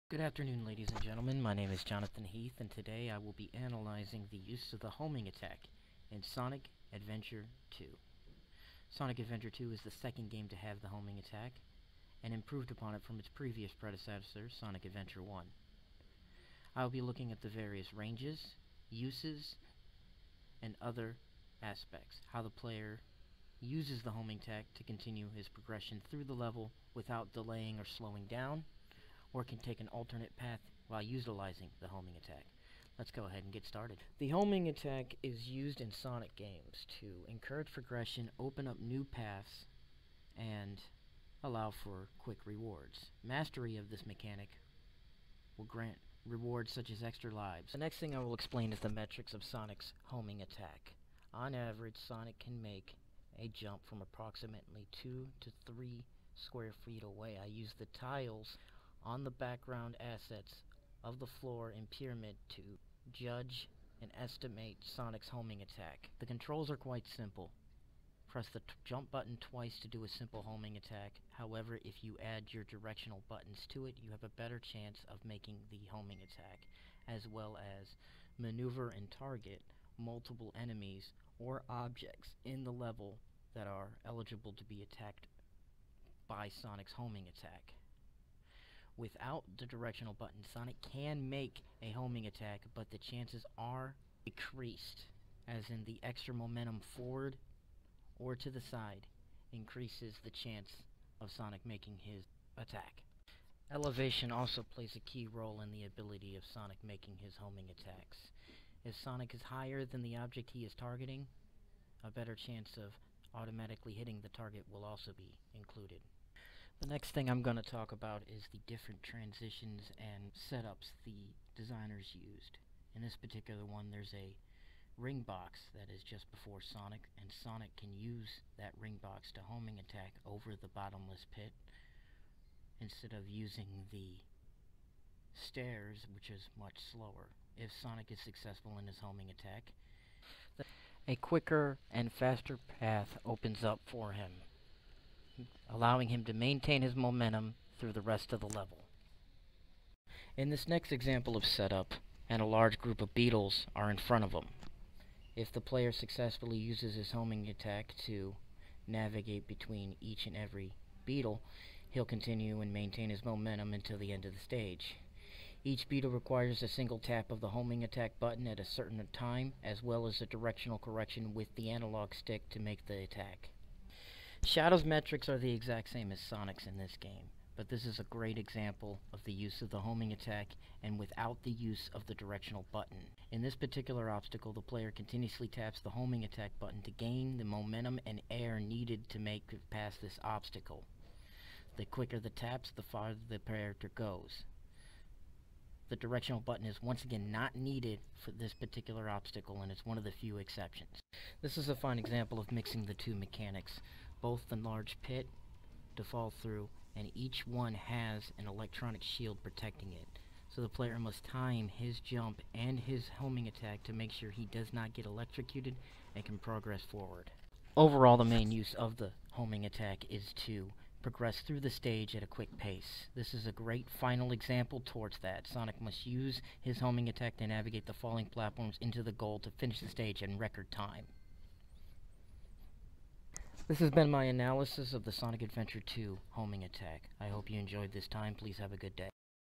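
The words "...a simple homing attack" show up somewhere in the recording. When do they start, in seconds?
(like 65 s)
70 s.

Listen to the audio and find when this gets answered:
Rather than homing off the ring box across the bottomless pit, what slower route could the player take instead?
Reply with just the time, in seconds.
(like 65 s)
133 s.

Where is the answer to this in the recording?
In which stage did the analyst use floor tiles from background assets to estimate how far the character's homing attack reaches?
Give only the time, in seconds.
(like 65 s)
61 s.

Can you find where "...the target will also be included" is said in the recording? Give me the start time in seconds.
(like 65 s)
114 s.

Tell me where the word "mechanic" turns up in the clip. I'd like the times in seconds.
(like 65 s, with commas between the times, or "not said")
44 s, 203 s.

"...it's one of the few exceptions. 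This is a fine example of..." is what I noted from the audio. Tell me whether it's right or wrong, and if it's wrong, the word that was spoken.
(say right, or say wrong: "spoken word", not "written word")
right.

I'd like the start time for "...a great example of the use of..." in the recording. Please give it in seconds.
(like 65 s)
177 s.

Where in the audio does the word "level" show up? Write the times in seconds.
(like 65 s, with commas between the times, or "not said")
26 s, 82 s, 148 s.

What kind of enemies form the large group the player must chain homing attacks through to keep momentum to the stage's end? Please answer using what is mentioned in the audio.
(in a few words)
beetles.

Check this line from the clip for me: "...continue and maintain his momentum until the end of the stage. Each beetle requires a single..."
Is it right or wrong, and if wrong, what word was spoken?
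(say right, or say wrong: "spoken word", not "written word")
right.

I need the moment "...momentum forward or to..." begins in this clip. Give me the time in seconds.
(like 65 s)
96 s.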